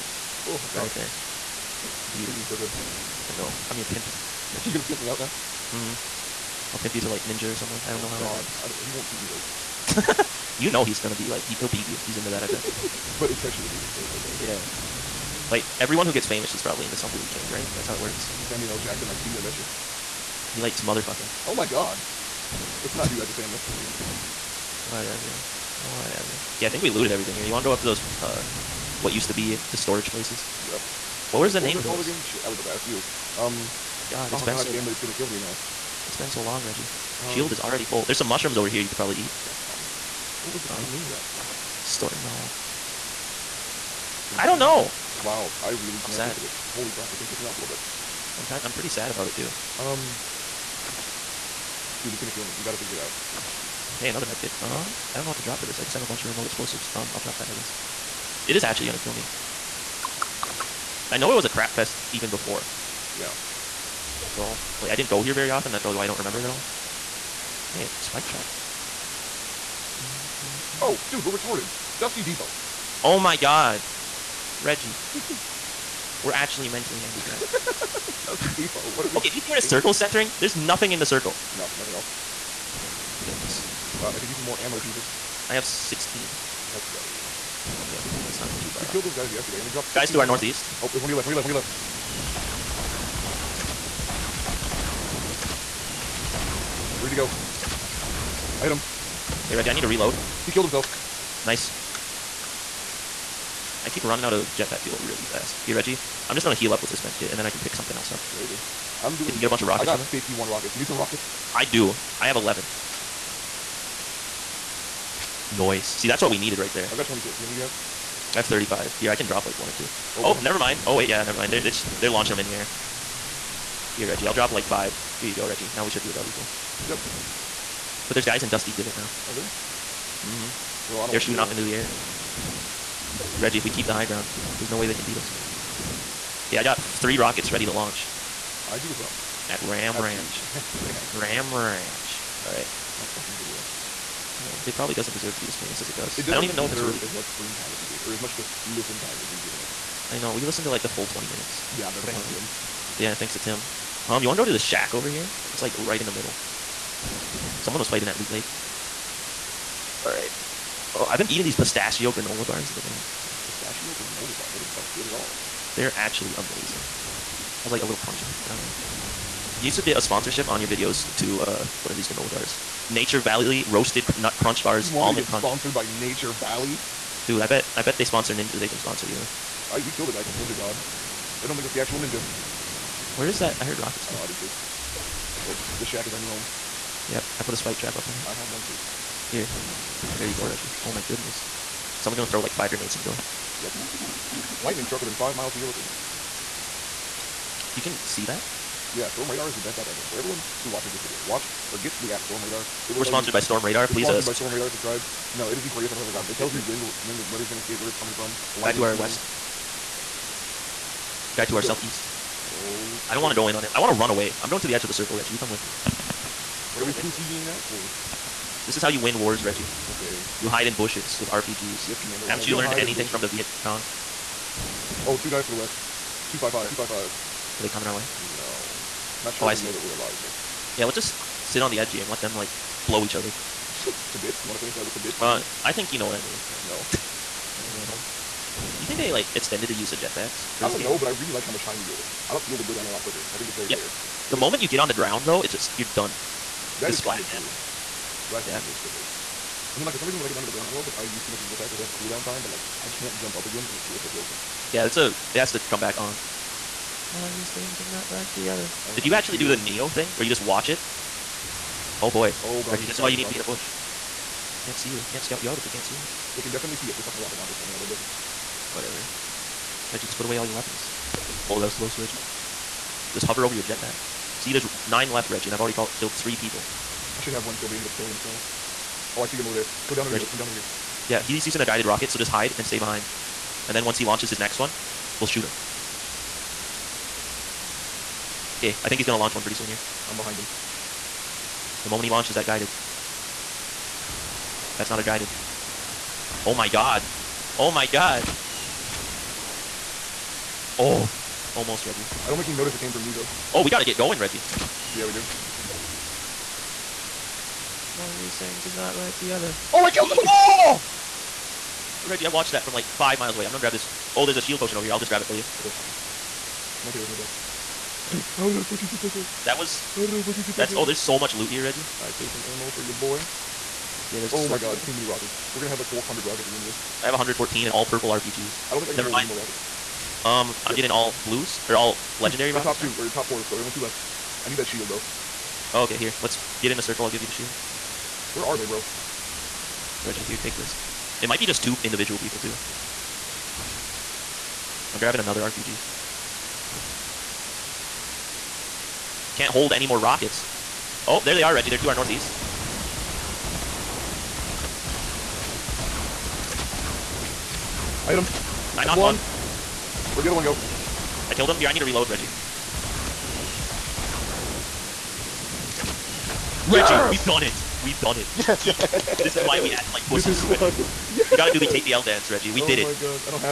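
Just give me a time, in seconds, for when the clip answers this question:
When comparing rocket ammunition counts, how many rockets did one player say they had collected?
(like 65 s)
110 s.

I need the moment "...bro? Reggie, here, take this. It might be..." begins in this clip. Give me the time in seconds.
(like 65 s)
338 s.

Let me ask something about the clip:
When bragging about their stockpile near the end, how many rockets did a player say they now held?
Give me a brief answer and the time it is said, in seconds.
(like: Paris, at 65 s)
114, at 327 s.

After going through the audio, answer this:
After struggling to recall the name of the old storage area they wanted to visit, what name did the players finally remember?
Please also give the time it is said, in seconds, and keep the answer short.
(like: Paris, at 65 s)
Dusty Depot, at 72 s.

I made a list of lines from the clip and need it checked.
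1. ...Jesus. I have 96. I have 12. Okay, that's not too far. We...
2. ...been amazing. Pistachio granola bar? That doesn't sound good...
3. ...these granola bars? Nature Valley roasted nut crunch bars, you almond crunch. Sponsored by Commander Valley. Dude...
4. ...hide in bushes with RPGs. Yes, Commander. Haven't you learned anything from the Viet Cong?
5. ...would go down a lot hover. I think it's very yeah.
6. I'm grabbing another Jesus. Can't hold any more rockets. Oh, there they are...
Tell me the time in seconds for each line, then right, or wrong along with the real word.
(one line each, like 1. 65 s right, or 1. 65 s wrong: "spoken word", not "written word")
1. 84 s wrong: "16", not "96"
2. 162 s right
3. 171 s wrong: "Nature", not "Commander"
4. 220 s right
5. 242 s wrong: "quicker", not "hover"
6. 344 s wrong: "RPG", not "Jesus".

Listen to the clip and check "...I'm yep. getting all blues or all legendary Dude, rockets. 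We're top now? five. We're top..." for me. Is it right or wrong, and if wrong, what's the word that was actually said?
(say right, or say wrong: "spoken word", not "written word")
wrong: "two", not "five".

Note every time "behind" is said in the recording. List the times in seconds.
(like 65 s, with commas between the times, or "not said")
282 s, 290 s.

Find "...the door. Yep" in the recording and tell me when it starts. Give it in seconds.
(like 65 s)
192 s.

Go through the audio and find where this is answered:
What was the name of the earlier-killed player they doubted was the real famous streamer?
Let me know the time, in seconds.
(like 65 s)
180 s.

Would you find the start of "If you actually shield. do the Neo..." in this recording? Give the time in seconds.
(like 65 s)
258 s.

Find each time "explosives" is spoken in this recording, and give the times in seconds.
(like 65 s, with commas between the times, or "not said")
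56 s.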